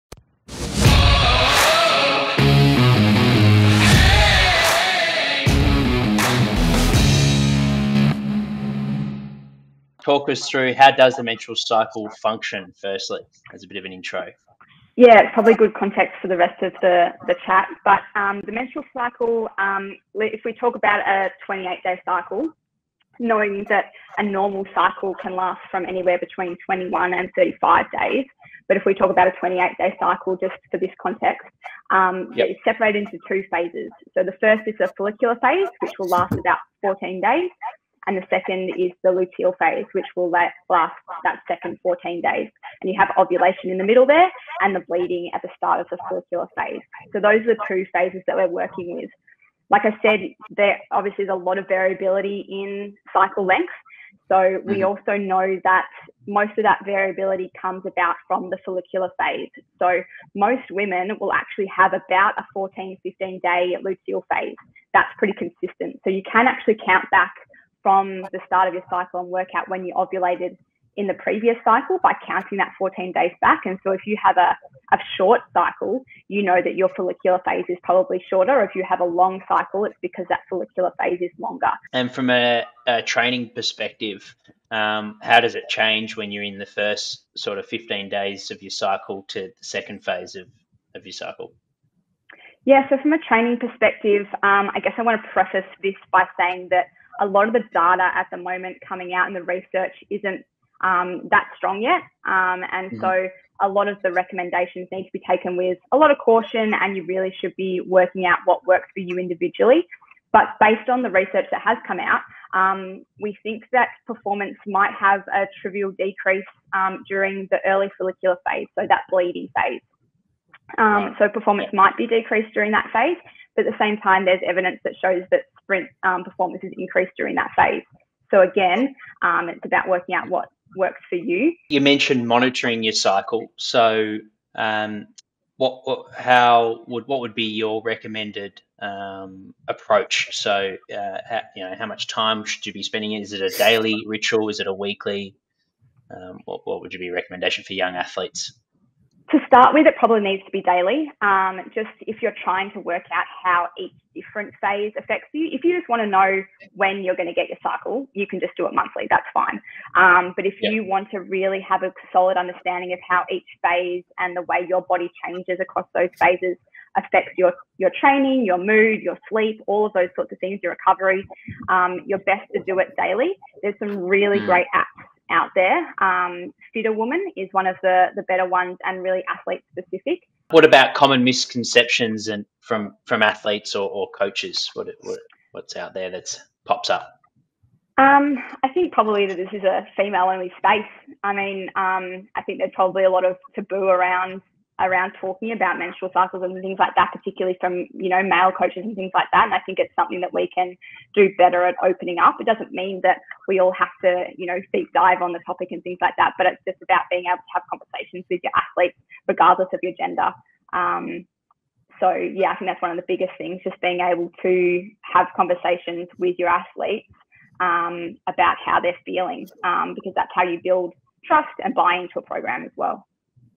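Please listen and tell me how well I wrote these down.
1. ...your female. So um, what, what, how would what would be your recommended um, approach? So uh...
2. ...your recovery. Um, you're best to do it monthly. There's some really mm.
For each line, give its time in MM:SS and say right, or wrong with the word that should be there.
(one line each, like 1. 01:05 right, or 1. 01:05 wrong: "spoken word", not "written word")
1. 02:12 wrong: "cycle", not "female"
2. 02:50 wrong: "daily", not "monthly".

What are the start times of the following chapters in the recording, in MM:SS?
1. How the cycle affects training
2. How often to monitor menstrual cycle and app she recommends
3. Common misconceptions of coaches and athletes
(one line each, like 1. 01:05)
1. 01:20
2. 02:11
3. 03:00.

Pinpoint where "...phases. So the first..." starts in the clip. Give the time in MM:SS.
00:33.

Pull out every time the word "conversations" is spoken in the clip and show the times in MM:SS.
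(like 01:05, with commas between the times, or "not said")
03:27, 03:35.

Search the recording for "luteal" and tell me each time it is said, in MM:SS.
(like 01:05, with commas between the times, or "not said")
00:39, 01:03.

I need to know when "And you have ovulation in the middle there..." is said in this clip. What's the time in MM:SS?
00:42.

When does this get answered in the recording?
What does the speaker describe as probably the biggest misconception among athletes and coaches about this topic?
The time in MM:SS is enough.
03:09.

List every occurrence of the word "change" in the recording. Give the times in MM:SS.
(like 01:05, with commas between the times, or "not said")
01:25, 02:45.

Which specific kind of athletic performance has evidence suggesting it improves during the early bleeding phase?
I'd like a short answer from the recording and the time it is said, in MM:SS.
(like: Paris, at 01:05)
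Sprint, at 02:05.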